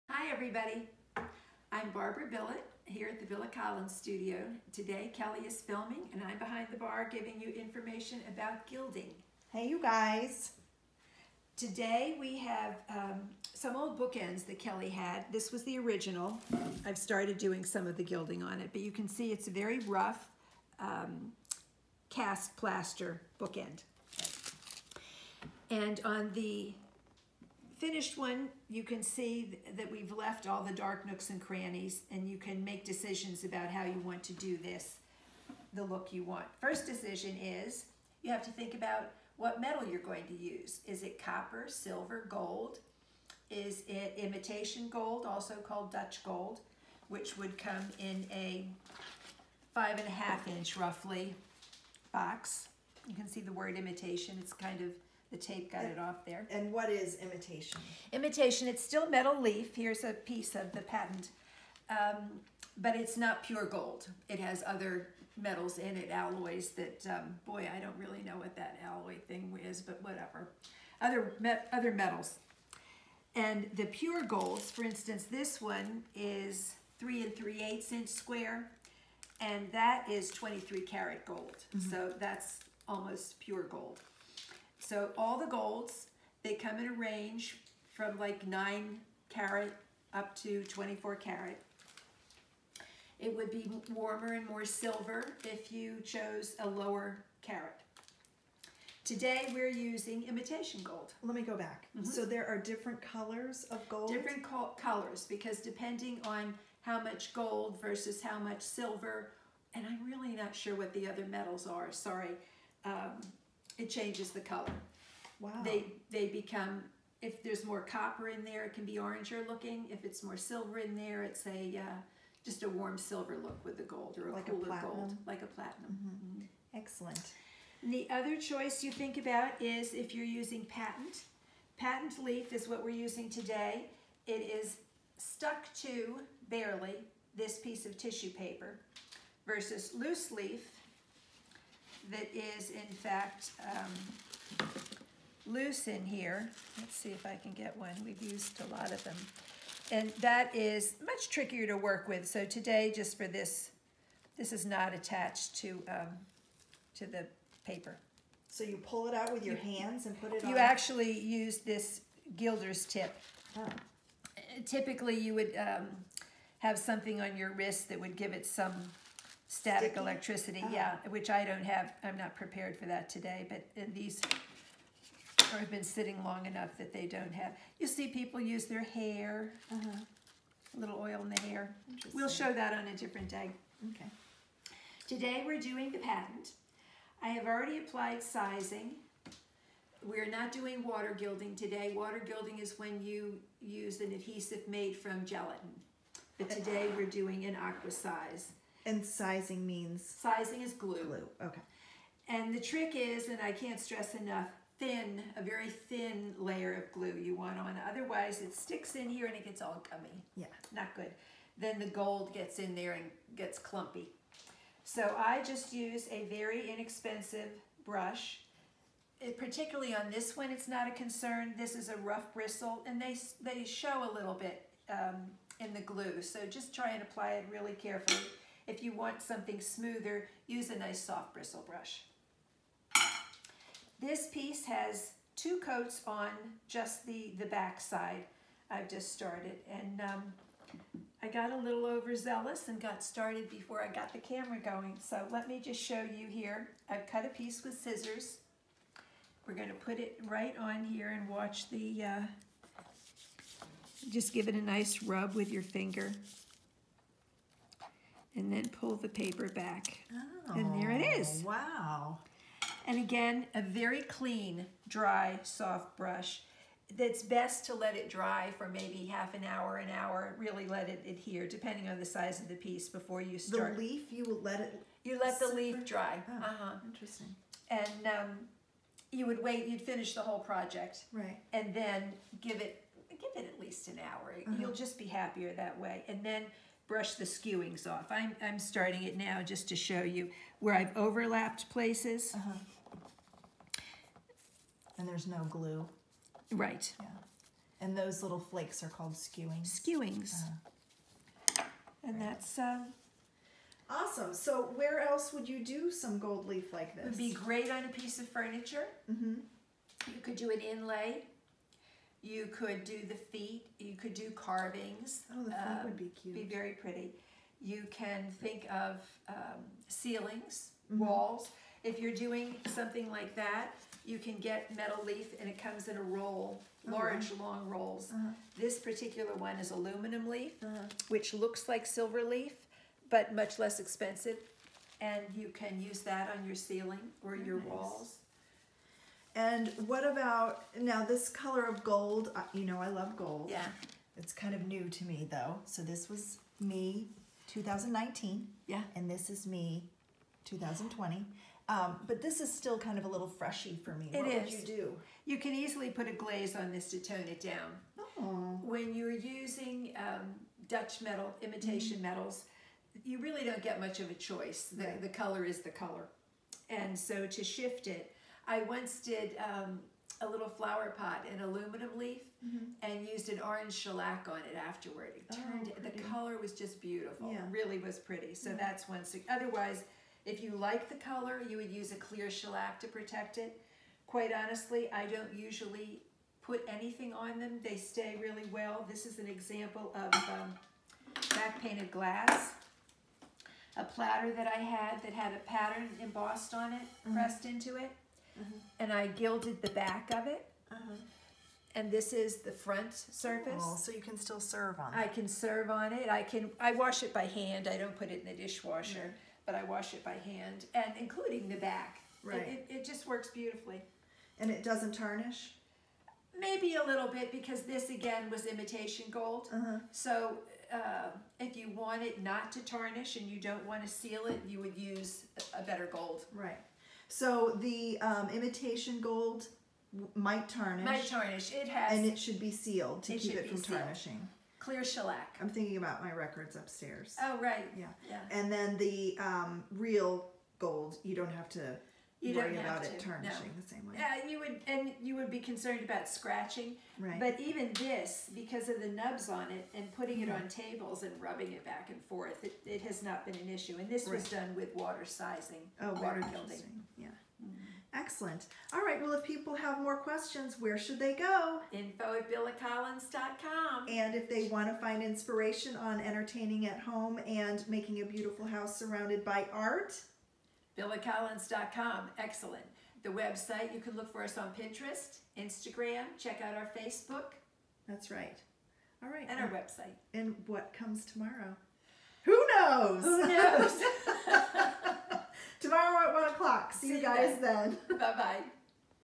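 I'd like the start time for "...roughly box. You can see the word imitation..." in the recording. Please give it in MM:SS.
00:50.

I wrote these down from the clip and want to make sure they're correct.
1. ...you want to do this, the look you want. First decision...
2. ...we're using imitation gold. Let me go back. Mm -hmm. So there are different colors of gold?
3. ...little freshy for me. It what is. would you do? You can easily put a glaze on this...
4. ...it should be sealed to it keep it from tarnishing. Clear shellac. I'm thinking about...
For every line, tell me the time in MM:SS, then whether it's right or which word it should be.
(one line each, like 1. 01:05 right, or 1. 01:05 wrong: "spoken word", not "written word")
1. 00:33 right
2. 01:39 right
3. 05:53 right
4. 07:12 right.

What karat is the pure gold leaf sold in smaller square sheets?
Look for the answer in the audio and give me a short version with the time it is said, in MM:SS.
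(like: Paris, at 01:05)
23 karat, at 01:20.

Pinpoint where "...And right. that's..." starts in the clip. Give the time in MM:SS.
05:02.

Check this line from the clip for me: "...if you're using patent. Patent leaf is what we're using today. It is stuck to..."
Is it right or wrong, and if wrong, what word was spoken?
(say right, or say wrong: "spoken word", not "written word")
right.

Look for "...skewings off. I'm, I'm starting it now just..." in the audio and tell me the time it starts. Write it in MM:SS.
04:47.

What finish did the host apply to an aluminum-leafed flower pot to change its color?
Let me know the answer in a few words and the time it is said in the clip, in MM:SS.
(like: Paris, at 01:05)
orange shellac, at 06:13.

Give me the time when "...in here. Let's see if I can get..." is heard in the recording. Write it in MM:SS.
02:25.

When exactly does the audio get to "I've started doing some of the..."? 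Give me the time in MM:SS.
00:16.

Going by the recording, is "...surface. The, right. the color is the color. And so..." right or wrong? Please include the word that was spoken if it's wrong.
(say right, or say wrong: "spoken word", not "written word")
wrong: "choice", not "surface".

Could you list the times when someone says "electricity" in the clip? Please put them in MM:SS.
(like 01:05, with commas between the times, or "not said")
02:49.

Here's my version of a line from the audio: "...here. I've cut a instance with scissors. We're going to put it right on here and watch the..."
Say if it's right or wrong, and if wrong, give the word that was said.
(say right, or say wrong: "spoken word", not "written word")
wrong: "piece", not "instance".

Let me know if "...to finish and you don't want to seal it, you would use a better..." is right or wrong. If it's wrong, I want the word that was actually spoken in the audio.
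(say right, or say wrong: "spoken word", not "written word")
wrong: "tarnish", not "finish".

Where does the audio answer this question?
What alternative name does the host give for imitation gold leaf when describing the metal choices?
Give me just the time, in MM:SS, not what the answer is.
00:45.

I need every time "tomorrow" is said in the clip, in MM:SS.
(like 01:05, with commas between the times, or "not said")
08:01, 08:05.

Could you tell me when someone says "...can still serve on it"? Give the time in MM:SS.
06:44.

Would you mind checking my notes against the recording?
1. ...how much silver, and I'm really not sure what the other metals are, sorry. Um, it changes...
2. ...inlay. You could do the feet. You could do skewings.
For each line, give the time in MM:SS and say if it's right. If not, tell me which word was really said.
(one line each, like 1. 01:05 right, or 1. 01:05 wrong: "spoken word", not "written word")
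1. 01:48 right
2. 05:10 wrong: "carvings", not "skewings".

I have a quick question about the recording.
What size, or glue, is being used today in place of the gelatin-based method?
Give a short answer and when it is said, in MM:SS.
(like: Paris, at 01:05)
aqua size, at 03:17.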